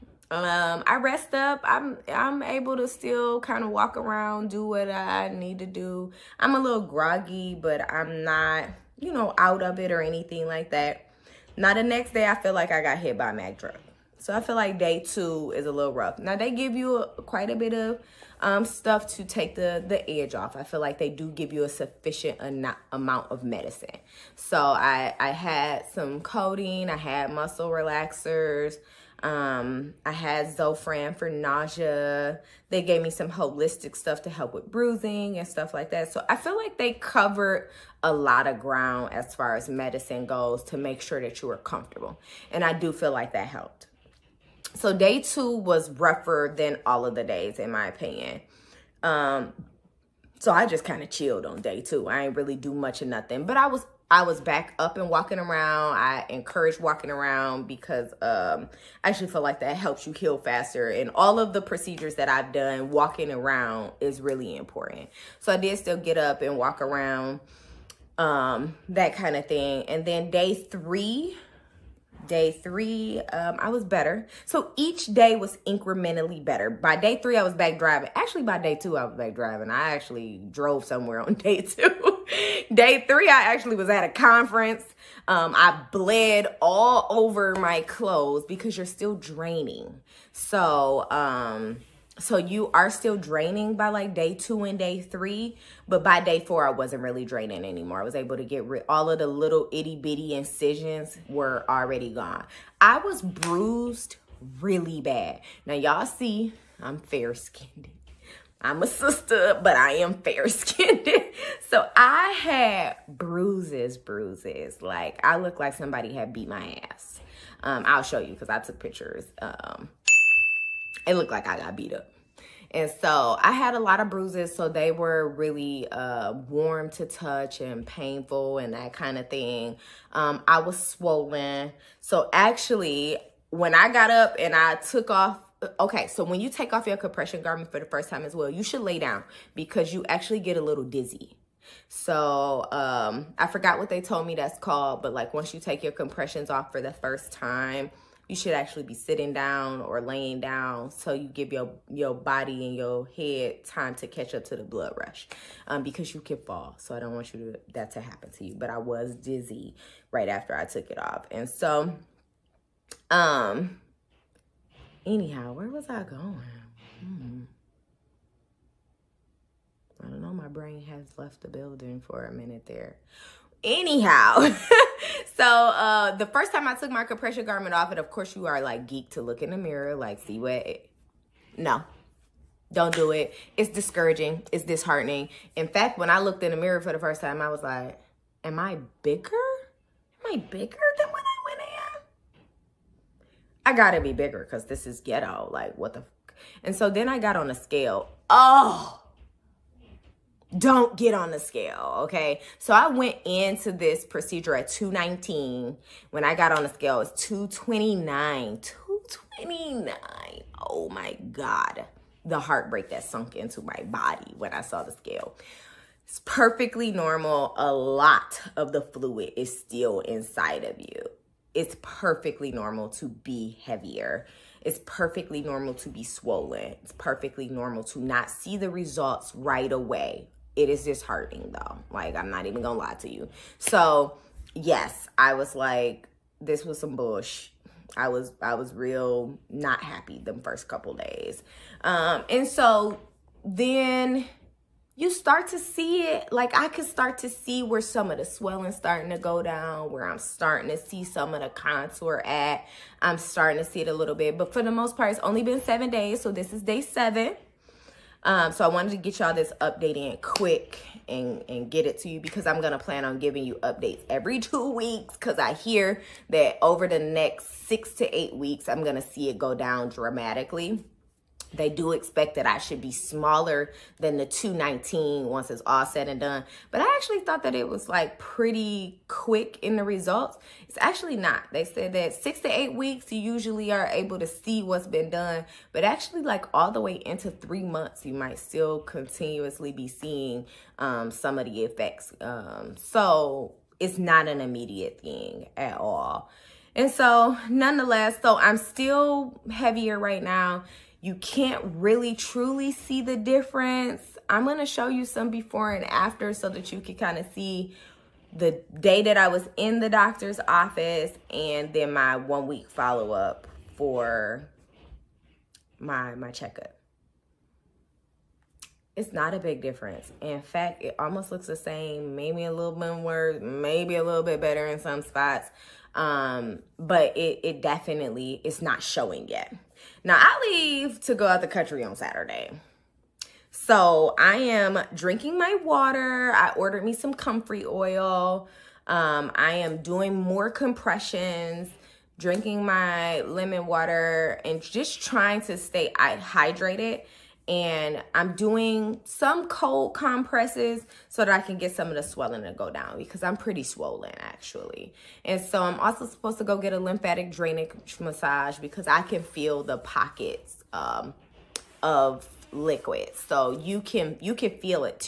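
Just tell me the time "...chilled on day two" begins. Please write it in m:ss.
0:51.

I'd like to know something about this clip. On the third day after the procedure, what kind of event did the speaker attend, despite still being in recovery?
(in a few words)
a conference.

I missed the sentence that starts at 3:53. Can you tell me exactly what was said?
So, yes, I was like, this was some bush.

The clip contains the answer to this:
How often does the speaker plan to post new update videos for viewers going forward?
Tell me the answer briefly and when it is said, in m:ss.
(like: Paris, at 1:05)
every 2 weeks, at 4:24.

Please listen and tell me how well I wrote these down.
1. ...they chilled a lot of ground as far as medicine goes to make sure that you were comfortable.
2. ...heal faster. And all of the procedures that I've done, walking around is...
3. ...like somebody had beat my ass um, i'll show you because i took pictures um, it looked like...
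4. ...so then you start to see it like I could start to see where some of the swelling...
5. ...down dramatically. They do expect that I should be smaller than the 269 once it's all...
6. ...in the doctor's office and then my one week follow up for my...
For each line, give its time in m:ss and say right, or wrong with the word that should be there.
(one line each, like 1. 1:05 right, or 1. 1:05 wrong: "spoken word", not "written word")
1. 0:36 wrong: "covered", not "chilled"
2. 1:00 right
3. 1:55 right
4. 4:02 right
5. 4:29 wrong: "219", not "269"
6. 5:09 right.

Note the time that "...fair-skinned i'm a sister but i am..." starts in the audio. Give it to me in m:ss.
1:46.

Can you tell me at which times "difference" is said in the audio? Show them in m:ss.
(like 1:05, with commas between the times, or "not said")
5:03, 5:19.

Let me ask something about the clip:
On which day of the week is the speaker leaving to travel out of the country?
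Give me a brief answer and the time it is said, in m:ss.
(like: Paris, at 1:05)
Saturday, at 5:31.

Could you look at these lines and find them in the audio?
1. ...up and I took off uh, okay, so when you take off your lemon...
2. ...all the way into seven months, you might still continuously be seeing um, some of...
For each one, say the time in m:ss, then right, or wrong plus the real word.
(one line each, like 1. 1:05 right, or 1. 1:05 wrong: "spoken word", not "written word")
1. 2:14 wrong: "compression", not "lemon"
2. 4:46 wrong: "three", not "seven".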